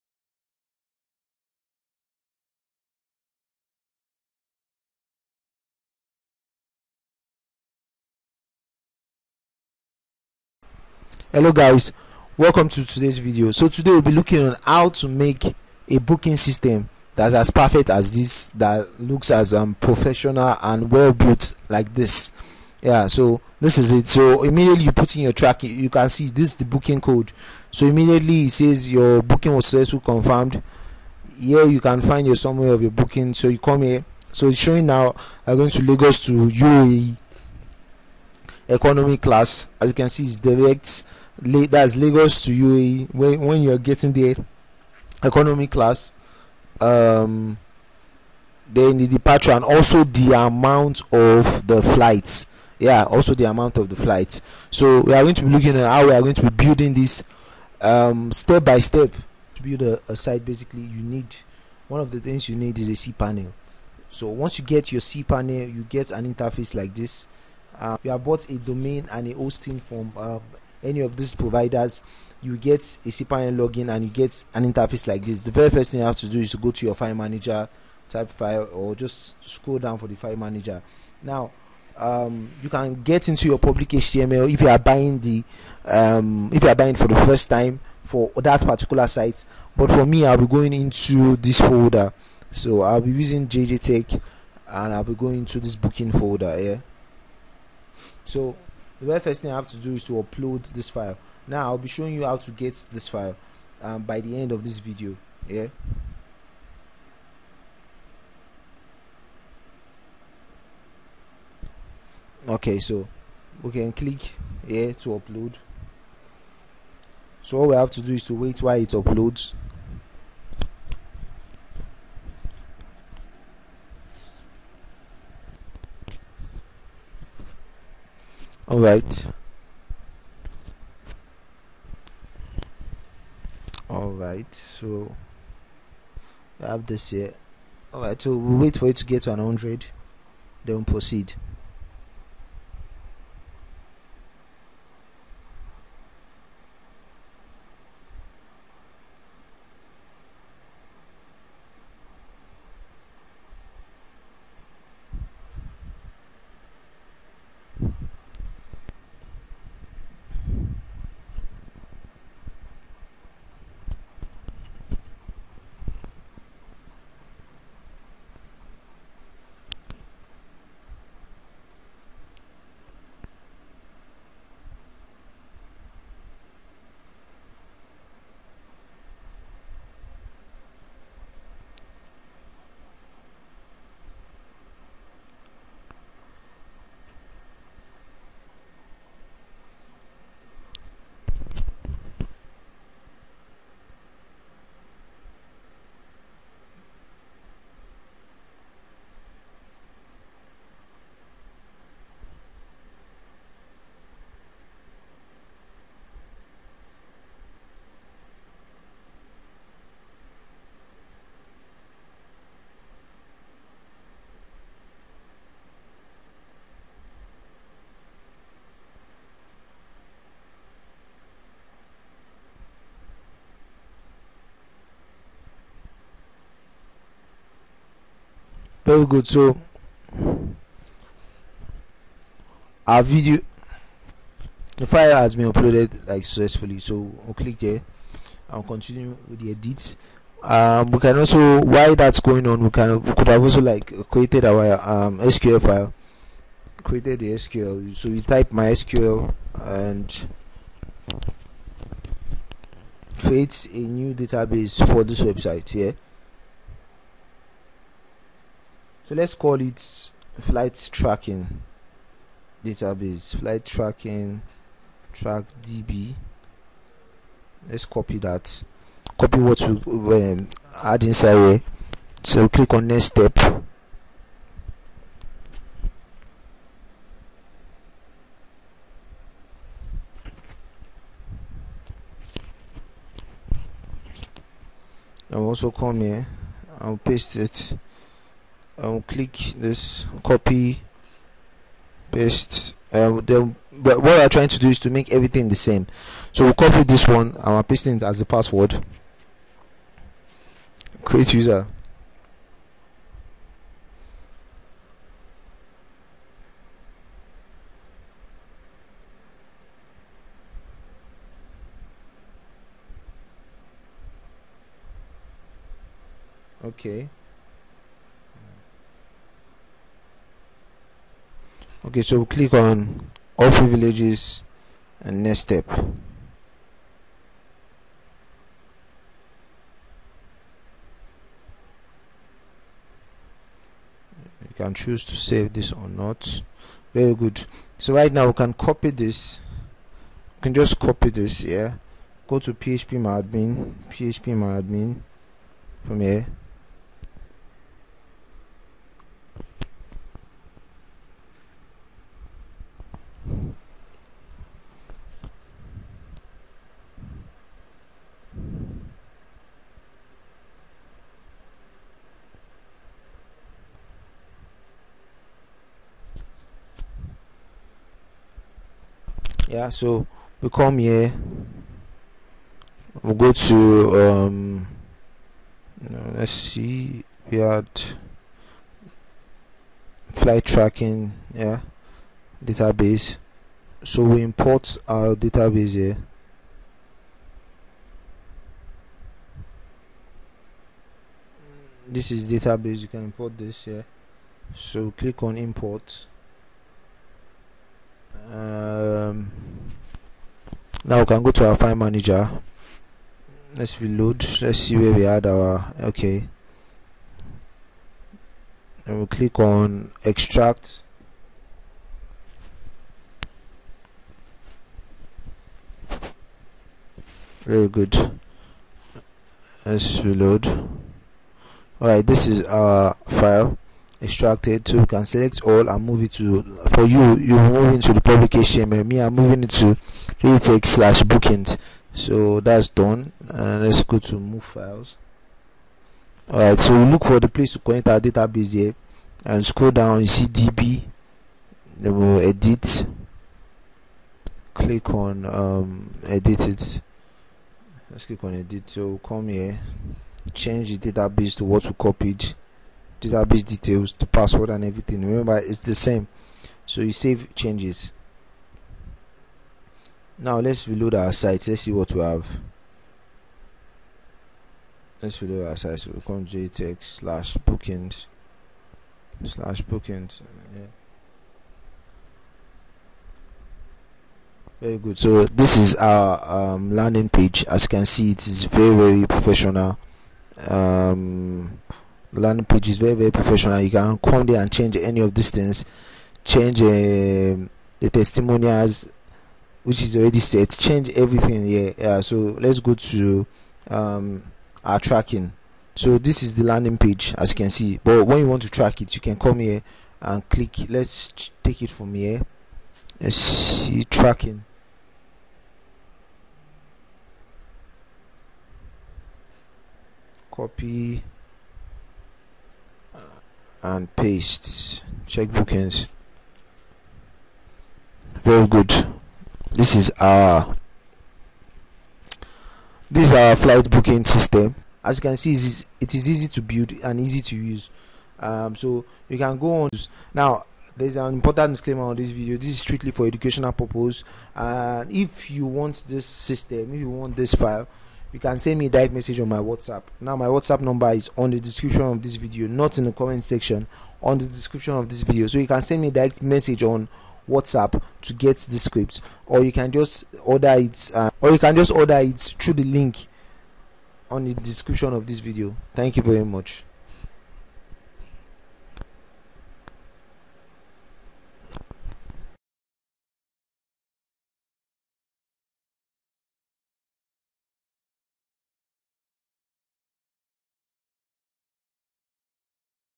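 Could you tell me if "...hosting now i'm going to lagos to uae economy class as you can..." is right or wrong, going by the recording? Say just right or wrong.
wrong.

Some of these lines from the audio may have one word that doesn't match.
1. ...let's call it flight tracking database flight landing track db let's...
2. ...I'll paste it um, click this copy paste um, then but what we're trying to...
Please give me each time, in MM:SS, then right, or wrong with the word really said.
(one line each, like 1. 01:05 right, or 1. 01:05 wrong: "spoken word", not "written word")
1. 04:19 wrong: "tracking", not "landing"
2. 04:46 right.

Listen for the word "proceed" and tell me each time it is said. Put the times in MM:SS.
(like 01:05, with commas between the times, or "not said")
02:20.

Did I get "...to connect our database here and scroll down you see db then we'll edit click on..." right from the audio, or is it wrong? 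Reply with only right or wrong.
right.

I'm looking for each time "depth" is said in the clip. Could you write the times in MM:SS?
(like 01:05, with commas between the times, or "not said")
not said.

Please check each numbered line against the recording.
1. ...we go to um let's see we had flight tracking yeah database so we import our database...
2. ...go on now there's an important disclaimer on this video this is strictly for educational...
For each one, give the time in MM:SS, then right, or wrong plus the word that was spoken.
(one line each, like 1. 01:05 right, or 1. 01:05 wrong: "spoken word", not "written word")
1. 06:13 right
2. 08:49 right.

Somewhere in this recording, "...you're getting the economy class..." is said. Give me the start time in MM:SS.
00:43.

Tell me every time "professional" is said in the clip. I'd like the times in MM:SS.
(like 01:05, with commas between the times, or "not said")
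00:19, 07:59, 08:03.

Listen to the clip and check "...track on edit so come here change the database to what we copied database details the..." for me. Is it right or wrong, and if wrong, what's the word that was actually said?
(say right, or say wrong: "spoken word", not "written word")
wrong: "click", not "track".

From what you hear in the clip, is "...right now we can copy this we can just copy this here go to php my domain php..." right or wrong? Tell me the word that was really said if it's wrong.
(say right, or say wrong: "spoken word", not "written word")
wrong: "admin", not "domain".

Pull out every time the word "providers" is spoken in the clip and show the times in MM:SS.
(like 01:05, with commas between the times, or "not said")
01:11.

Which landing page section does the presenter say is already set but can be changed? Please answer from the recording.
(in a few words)
Testimonials.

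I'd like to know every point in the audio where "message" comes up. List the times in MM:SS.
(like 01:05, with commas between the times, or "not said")
08:58, 09:06.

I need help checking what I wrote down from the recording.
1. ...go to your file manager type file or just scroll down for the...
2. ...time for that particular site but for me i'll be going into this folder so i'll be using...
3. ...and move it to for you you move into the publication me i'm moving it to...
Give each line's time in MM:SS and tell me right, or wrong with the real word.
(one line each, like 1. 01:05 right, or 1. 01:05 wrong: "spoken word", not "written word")
1. 01:16 right
2. 01:27 right
3. 07:05 right.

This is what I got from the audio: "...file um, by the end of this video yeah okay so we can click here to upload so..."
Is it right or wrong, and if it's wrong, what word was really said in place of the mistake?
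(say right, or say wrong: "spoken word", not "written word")
right.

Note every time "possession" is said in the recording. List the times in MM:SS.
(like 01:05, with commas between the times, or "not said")
not said.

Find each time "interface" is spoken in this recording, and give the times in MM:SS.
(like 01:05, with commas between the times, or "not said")
01:06, 01:14.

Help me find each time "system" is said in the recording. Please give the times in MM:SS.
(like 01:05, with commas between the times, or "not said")
00:16, 08:44, 08:56.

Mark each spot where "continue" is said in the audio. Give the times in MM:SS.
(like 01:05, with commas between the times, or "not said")
03:58.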